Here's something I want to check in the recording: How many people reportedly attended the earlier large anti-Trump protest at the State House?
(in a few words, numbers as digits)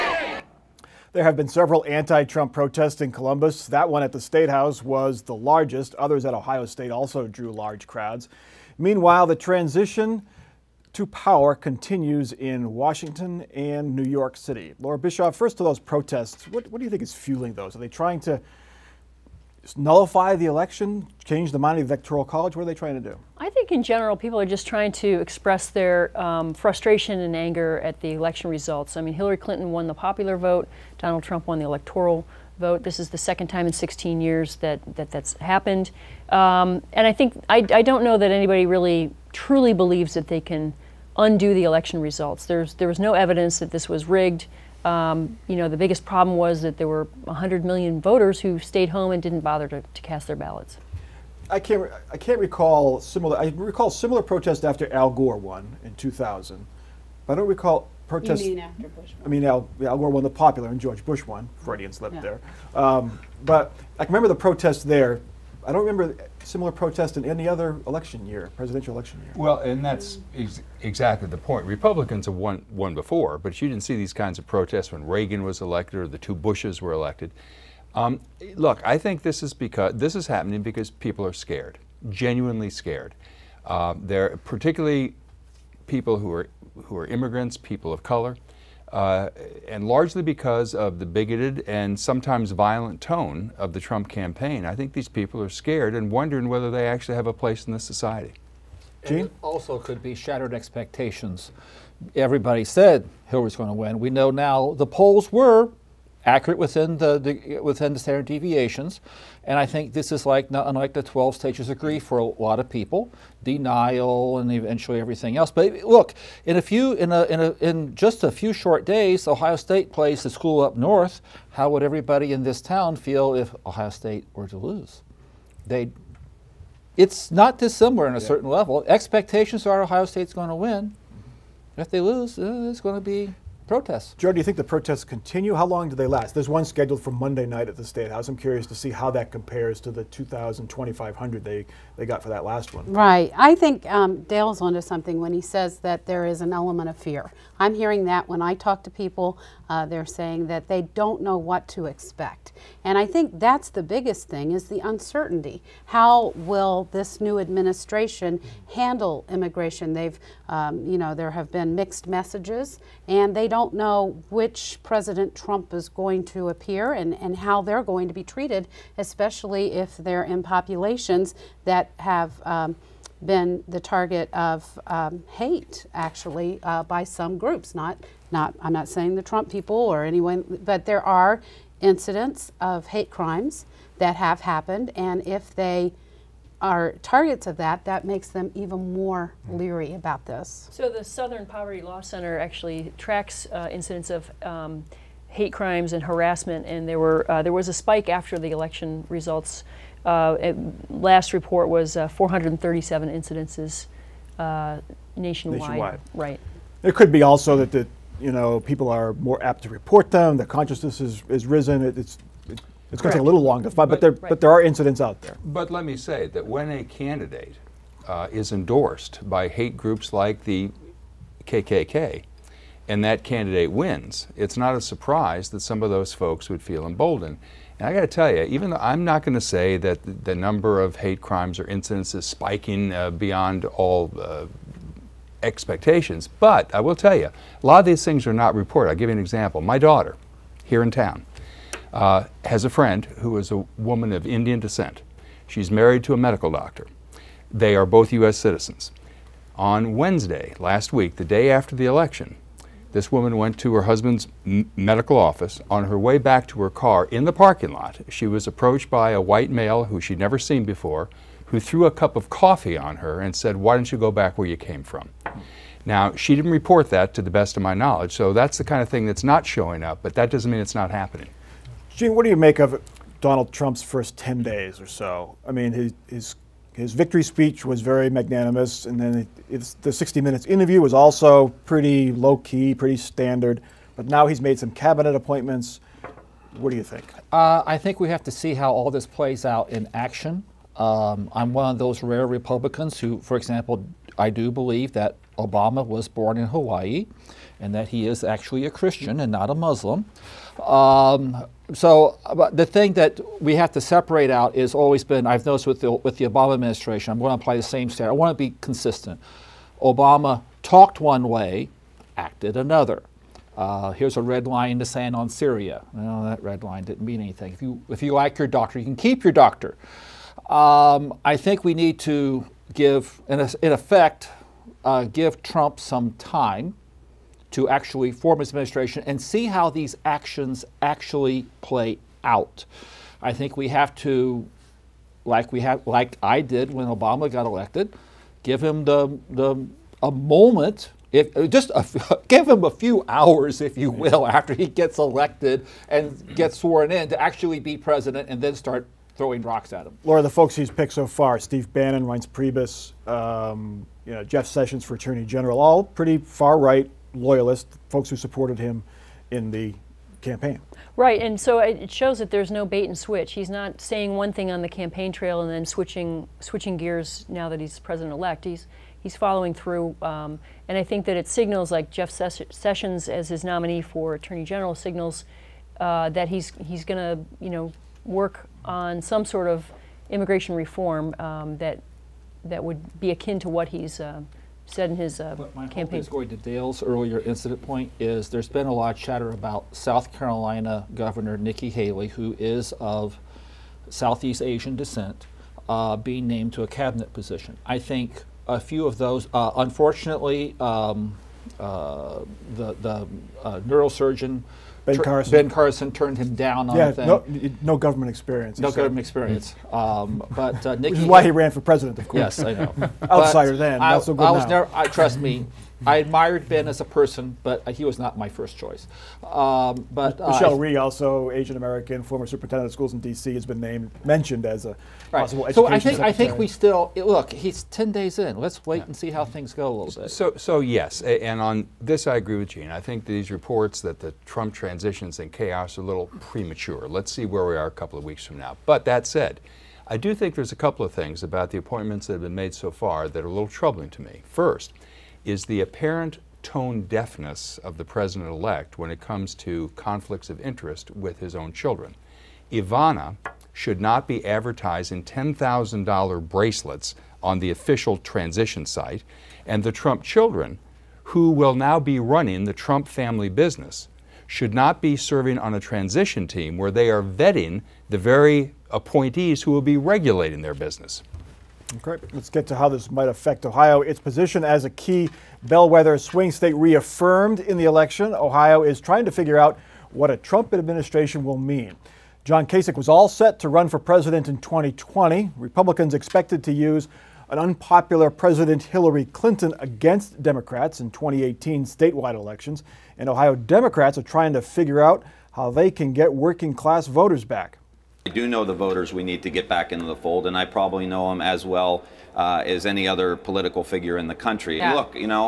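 2,000 to 2,500.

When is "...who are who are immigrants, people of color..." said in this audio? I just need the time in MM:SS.
01:26.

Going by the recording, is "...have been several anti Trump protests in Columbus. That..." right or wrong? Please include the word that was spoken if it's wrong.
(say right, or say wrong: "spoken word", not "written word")
right.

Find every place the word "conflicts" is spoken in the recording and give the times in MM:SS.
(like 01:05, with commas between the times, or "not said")
07:29.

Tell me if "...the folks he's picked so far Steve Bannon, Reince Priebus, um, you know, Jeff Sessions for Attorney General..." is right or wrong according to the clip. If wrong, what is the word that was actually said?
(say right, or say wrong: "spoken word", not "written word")
right.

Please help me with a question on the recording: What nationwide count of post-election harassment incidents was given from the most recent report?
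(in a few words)
437.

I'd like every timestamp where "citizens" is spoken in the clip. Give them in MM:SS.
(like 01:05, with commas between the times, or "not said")
04:08.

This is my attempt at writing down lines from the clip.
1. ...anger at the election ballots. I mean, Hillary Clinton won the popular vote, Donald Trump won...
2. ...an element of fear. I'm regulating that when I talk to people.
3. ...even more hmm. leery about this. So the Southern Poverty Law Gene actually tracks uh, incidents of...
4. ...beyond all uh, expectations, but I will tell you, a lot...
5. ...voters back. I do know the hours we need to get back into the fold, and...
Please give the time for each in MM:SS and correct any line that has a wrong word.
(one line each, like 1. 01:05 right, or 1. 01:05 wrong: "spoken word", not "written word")
1. 00:27 wrong: "results", not "ballots"
2. 02:26 wrong: "hearing", not "regulating"
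3. 03:08 wrong: "Center", not "Gene"
4. 03:53 right
5. 08:16 wrong: "voters", not "hours".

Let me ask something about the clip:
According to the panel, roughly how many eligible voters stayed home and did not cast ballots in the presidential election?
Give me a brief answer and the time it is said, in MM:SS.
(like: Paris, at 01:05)
100 million, at 00:47.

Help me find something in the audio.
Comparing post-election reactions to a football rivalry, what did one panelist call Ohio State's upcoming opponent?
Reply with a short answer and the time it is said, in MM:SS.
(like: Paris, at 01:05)
the school up north, at 02:00.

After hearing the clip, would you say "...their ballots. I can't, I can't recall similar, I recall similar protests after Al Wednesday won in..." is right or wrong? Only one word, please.
wrong.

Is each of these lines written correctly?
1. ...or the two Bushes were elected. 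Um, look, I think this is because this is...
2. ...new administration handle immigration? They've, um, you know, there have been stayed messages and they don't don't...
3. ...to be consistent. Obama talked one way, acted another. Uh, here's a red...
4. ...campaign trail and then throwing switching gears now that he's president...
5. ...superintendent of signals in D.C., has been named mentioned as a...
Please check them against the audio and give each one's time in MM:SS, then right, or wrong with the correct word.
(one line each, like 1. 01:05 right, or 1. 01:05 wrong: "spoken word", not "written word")
1. 01:16 right
2. 02:37 wrong: "mixed", not "stayed"
3. 05:08 right
4. 06:04 wrong: "switching", not "throwing"
5. 07:02 wrong: "schools", not "signals".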